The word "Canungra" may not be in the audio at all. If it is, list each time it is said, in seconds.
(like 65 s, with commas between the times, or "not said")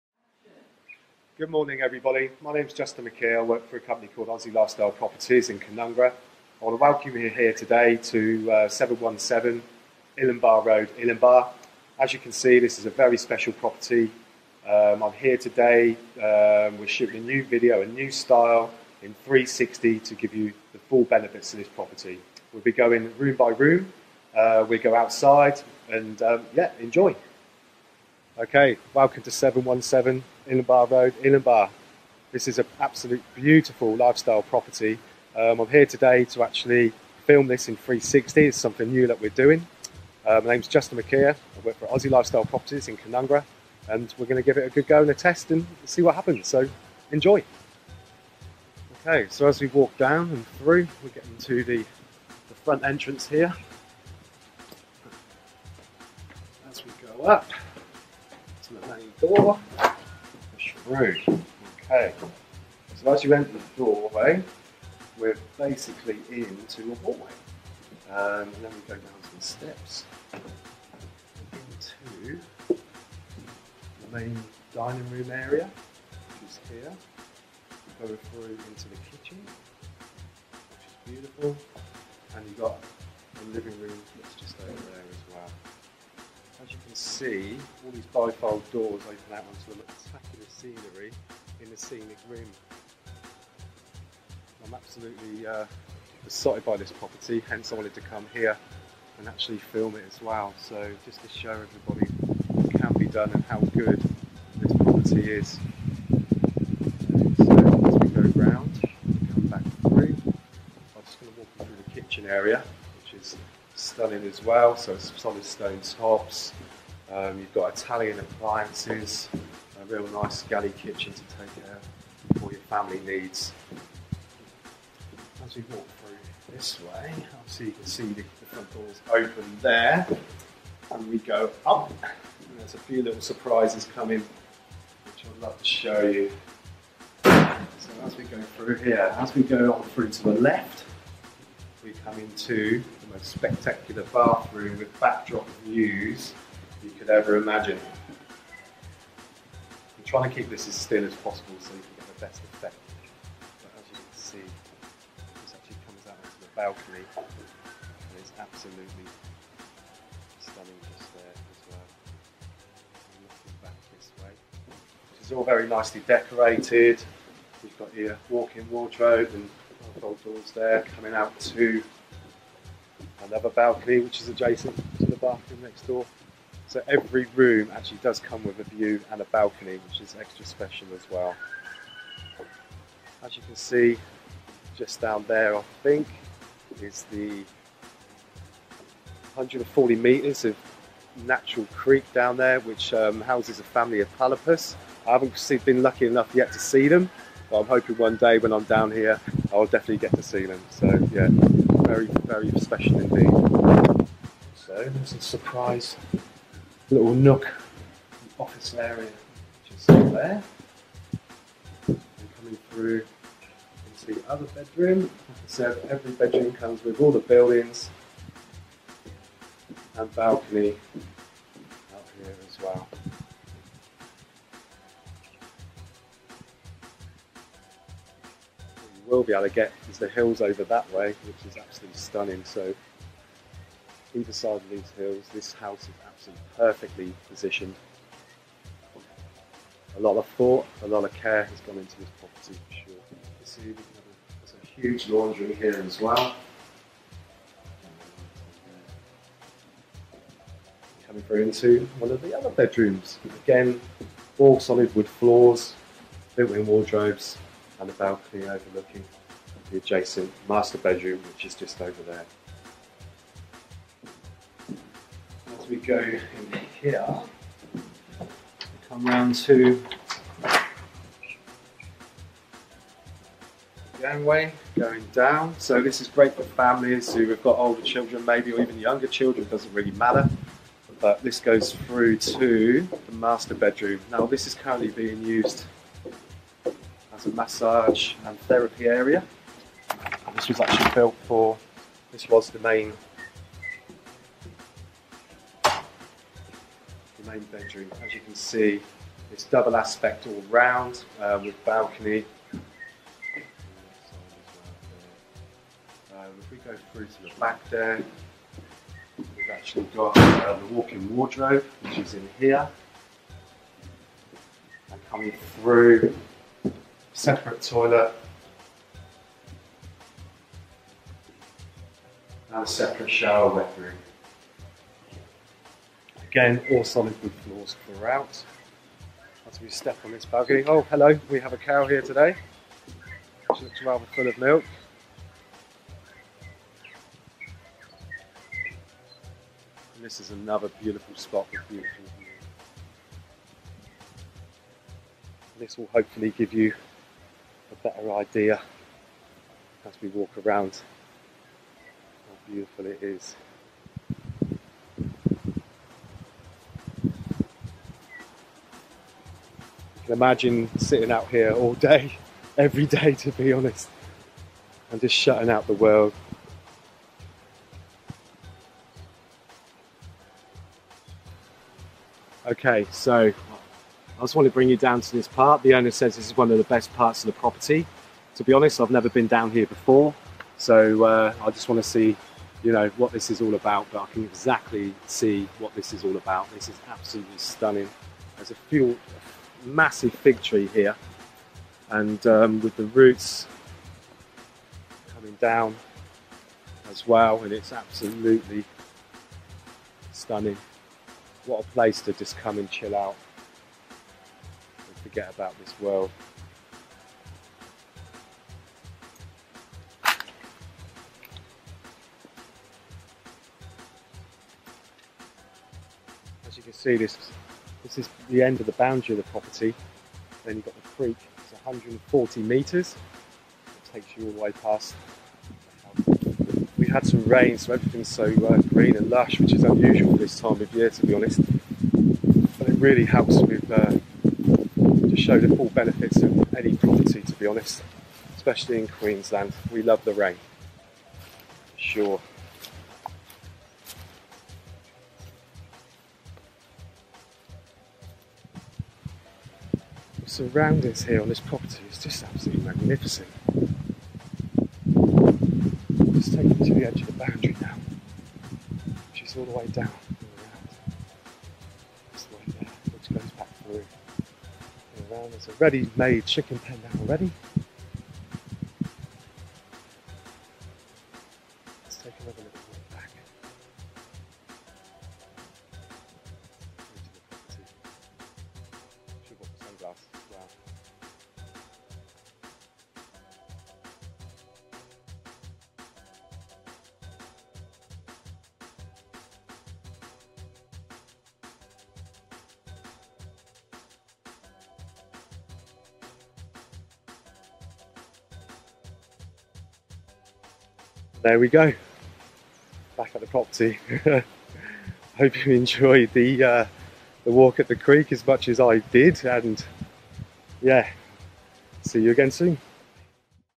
5 s, 42 s.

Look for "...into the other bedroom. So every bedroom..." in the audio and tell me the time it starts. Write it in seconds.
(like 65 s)
213 s.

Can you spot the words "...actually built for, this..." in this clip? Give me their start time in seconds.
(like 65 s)
290 s.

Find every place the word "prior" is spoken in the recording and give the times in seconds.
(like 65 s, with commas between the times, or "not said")
not said.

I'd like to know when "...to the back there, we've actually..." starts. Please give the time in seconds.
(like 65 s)
307 s.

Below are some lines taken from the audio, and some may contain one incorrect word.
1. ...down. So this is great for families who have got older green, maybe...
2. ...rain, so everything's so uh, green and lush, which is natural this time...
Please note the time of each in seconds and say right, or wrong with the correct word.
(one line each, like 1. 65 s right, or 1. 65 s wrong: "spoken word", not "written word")
1. 275 s wrong: "children", not "green"
2. 427 s wrong: "unusual", not "natural".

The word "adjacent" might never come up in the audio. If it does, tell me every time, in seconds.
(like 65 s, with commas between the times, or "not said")
174 s, 259 s.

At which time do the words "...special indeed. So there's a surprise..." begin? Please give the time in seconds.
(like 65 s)
202 s.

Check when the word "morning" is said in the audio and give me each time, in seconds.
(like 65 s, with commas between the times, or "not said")
1 s.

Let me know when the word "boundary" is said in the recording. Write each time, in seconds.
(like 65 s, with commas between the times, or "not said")
418 s, 457 s.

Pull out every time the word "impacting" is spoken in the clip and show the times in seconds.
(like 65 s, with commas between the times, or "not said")
not said.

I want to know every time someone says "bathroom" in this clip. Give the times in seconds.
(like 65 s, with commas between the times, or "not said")
144 s, 175 s.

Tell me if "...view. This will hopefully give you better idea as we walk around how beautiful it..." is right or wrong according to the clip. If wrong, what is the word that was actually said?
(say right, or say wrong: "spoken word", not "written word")
right.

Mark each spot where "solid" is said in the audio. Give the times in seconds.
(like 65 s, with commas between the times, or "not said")
114 s, 254 s, 326 s.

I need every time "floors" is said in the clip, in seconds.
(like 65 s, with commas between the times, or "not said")
255 s, 327 s.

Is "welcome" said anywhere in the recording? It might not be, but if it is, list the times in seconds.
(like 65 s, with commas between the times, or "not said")
6 s, 28 s.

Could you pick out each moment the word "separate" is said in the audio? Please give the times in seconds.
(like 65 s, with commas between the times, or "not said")
317 s, 322 s.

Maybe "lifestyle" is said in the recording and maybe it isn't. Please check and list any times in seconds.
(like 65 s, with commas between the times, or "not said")
4 s, 33 s, 42 s.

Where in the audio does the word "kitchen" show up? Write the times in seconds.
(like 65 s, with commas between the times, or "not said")
79 s, 112 s, 120 s.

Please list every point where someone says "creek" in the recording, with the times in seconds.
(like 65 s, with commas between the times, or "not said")
191 s, 421 s, 507 s.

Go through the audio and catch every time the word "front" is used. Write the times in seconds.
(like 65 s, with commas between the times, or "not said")
52 s, 128 s.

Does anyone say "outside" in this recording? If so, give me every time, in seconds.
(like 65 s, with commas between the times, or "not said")
24 s.